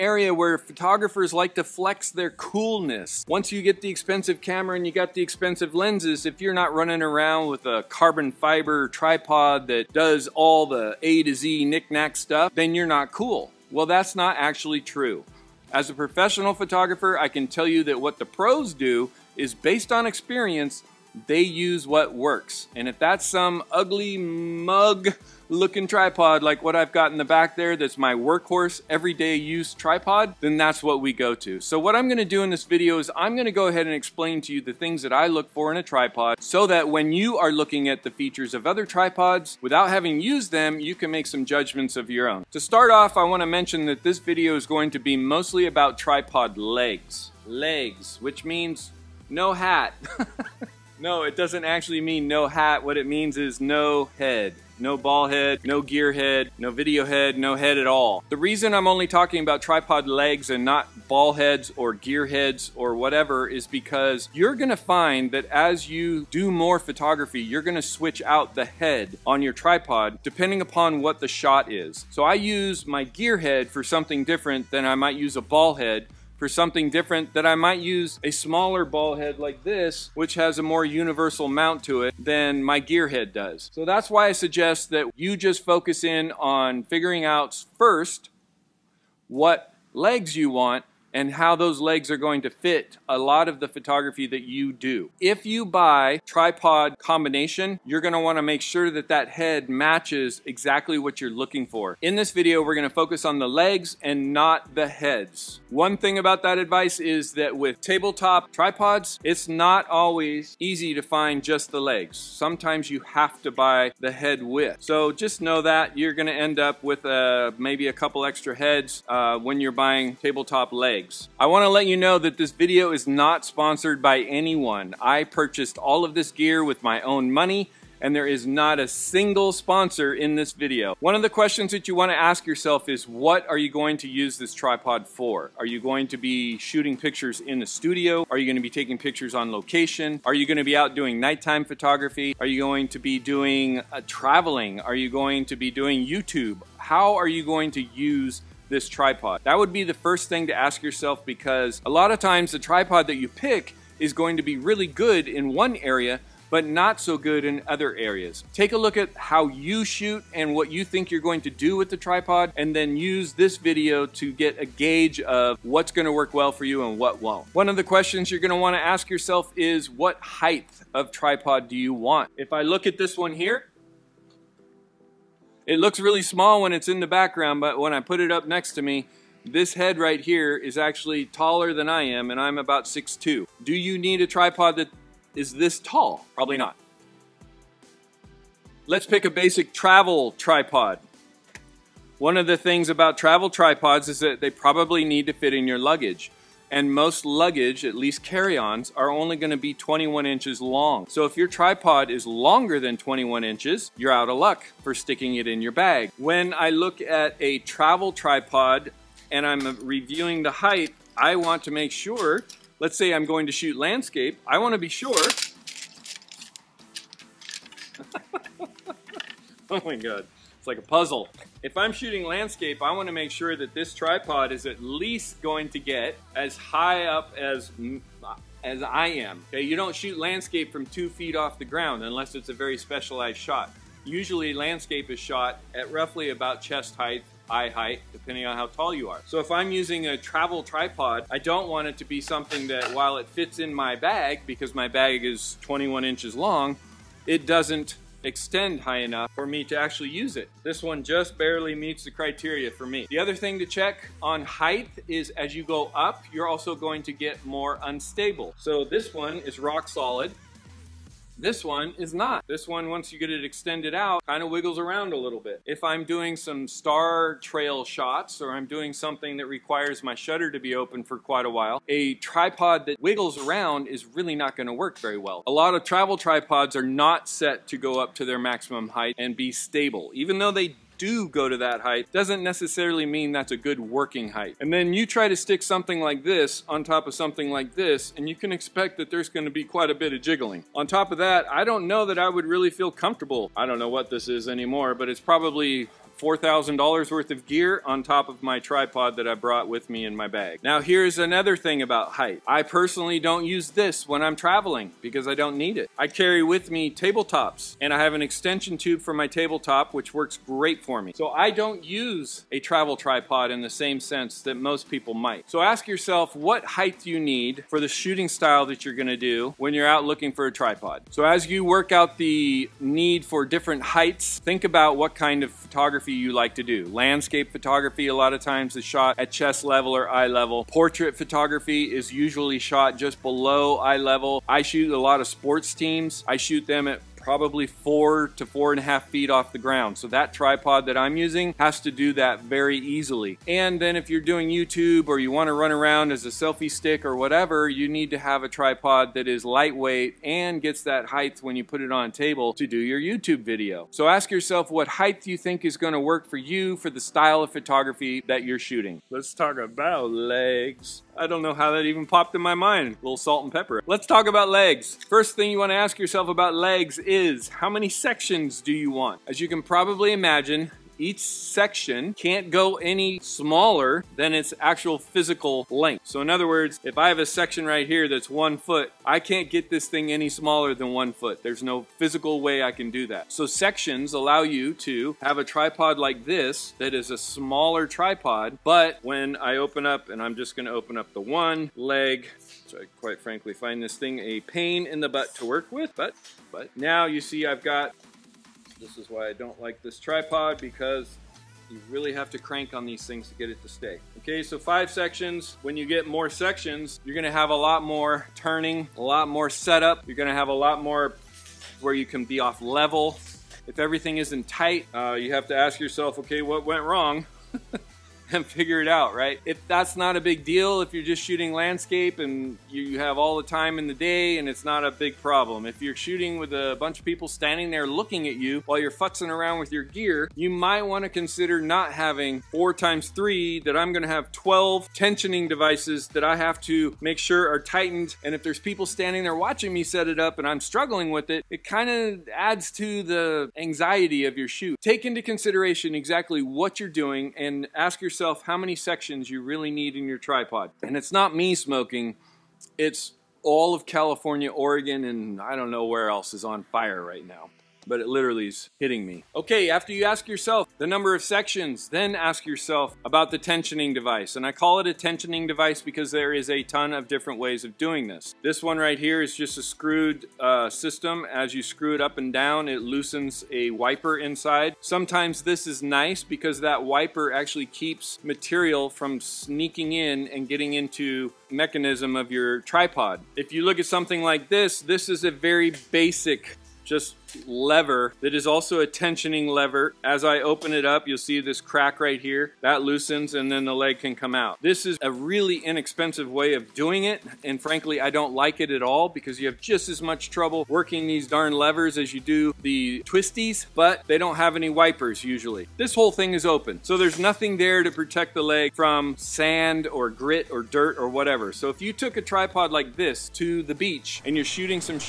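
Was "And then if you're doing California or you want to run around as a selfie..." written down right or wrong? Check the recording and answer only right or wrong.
wrong.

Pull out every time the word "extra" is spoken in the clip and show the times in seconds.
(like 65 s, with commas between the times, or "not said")
118 s.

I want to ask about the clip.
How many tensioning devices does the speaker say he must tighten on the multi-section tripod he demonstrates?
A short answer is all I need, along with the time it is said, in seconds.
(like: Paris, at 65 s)
12, at 434 s.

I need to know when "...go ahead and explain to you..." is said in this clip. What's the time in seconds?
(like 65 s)
33 s.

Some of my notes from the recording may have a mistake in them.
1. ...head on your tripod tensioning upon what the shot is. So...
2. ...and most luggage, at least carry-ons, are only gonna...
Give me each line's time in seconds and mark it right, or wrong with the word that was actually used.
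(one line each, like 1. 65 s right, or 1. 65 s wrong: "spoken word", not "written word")
1. 68 s wrong: "depending", not "tensioning"
2. 196 s right.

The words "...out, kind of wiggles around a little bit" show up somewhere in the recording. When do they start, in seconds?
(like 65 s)
263 s.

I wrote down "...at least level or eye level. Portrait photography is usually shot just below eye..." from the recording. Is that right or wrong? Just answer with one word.
wrong.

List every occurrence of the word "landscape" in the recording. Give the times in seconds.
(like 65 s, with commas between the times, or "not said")
213 s, 222 s, 230 s, 234 s, 326 s, 421 s.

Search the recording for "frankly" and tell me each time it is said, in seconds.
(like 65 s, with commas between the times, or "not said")
393 s, 497 s.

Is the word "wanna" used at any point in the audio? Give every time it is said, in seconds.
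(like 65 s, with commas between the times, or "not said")
43 s, 121 s, 168 s, 214 s, 222 s.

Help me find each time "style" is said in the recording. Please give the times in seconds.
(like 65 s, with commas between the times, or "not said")
318 s, 357 s.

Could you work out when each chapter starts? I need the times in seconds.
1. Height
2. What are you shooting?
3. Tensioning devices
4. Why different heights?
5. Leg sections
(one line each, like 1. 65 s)
1. 166 s
2. 130 s
3. 458 s
4. 320 s
5. 358 s.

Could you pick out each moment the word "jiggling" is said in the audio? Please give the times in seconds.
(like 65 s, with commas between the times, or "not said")
290 s.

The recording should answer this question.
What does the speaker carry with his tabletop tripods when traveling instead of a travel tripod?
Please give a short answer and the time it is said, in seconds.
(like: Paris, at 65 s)
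An extension tube, at 308 s.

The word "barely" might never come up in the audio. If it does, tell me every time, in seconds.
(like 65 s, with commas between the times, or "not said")
251 s.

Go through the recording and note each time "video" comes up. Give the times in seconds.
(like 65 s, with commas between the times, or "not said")
32 s, 44 s, 56 s, 102 s, 122 s, 130 s, 163 s, 353 s.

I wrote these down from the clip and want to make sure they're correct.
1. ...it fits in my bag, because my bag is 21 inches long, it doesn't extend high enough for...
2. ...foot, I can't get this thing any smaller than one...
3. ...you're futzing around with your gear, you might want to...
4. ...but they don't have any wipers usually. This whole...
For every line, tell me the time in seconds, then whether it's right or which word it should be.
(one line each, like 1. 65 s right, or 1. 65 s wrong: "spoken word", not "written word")
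1. 243 s right
2. 378 s right
3. 428 s right
4. 503 s right.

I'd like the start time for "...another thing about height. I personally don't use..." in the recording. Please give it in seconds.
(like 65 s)
301 s.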